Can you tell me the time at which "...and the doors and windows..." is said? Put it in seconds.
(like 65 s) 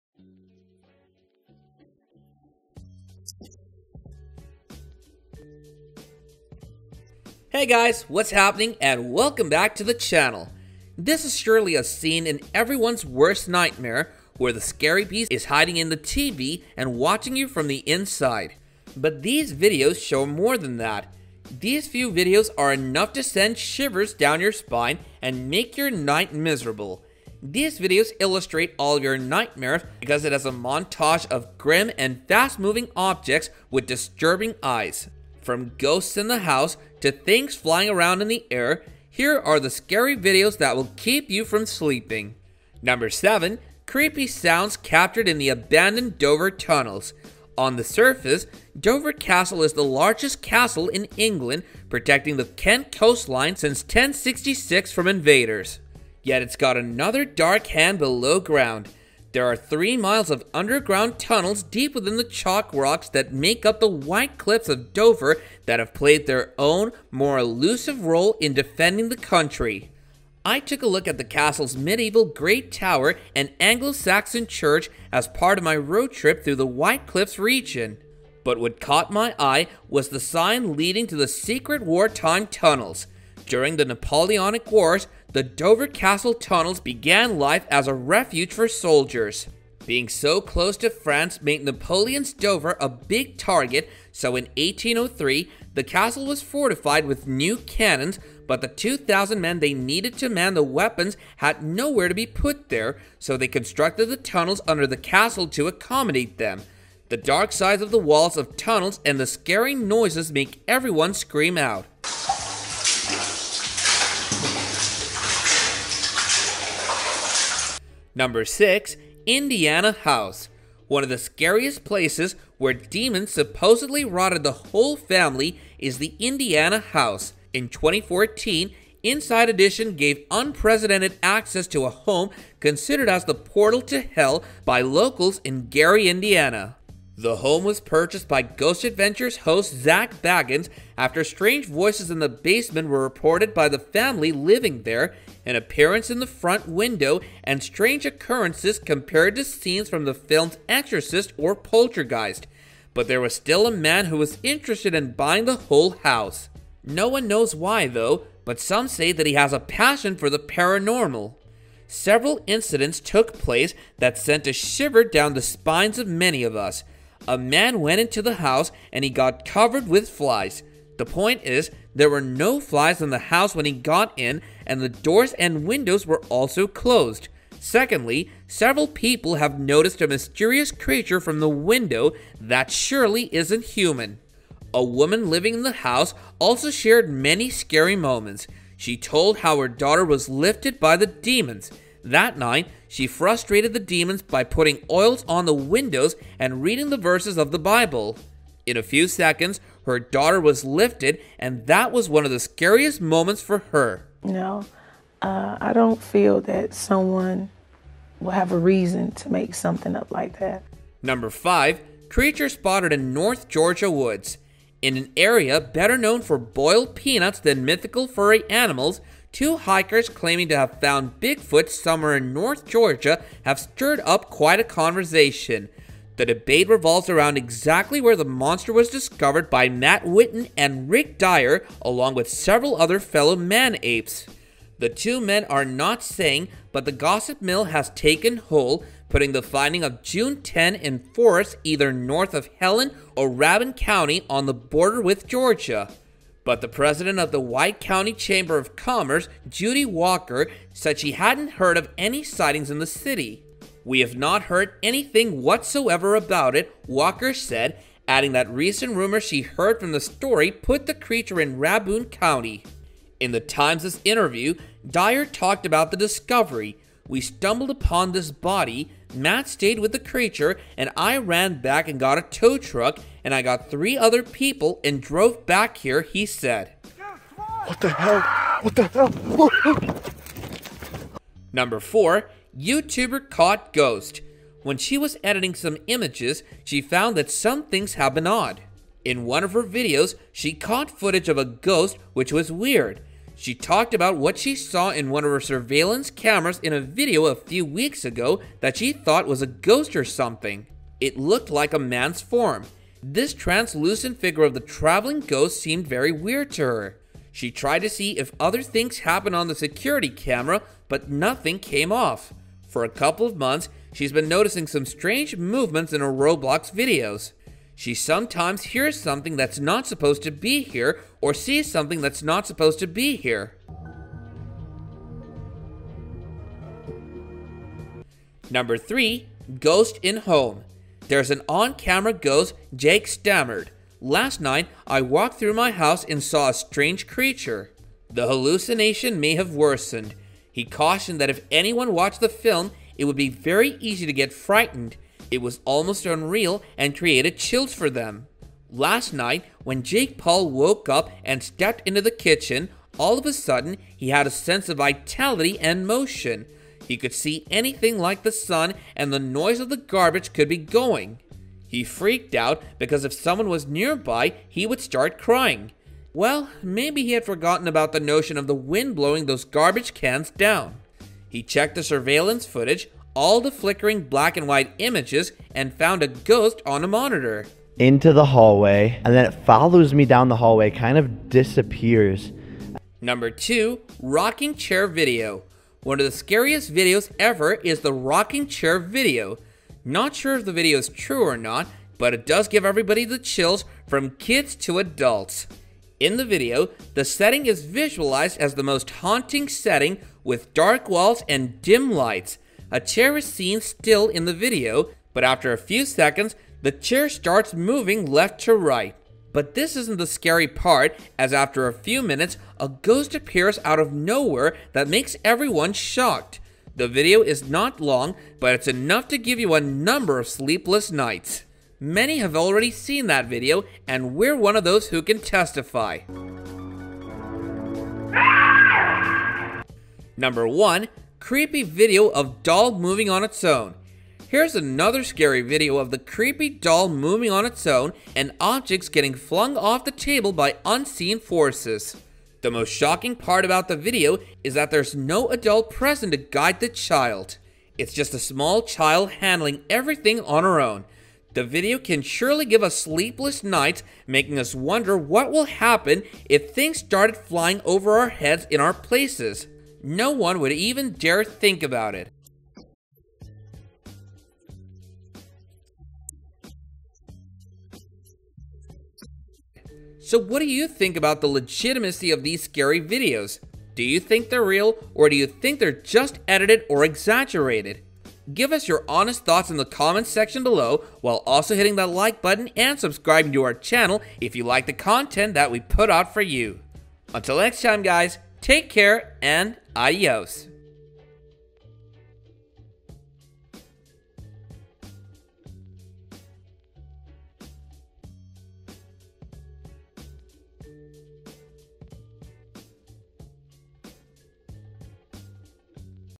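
174 s.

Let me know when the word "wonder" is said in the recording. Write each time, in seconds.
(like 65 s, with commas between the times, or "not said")
454 s.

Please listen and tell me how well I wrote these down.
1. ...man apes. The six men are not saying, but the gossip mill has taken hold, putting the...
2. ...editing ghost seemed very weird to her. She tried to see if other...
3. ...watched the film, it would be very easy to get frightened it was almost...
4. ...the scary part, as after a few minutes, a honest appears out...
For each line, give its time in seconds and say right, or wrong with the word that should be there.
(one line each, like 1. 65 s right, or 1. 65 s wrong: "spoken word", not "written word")
1. 233 s wrong: "two", not "six"
2. 304 s wrong: "traveling", not "editing"
3. 341 s right
4. 409 s wrong: "ghost", not "honest".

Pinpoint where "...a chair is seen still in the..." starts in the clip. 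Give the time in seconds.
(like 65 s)
402 s.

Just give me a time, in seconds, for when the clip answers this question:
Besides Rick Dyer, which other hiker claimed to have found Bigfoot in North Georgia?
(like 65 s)
229 s.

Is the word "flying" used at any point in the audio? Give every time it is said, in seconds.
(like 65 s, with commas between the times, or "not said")
37 s, 457 s.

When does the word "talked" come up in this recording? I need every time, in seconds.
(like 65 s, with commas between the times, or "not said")
265 s, 293 s.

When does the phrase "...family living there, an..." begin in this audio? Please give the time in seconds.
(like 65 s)
143 s.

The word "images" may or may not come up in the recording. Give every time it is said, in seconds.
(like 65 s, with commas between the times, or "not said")
285 s, 374 s.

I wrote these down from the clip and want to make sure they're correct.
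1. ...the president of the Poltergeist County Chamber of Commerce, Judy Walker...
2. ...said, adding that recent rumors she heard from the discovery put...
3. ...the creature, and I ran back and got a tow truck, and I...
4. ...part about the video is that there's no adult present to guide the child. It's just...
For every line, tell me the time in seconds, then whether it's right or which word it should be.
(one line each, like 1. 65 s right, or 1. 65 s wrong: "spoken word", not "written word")
1. 246 s wrong: "White", not "Poltergeist"
2. 257 s wrong: "story", not "discovery"
3. 269 s right
4. 443 s right.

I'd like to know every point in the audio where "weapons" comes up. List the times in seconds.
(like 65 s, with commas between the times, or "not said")
100 s.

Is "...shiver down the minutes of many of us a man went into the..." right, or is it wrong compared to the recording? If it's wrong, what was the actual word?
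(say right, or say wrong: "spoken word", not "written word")
wrong: "spines", not "minutes".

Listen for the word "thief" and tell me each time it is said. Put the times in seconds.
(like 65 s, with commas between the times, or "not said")
not said.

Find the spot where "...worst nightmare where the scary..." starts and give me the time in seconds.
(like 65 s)
13 s.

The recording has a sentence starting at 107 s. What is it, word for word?
The dark sides of the walls of tunnels and the scary noises make everyone scream out.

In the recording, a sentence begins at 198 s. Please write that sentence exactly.
In a few seconds, her daughter was lifted, and that was one of the scariest moments for her.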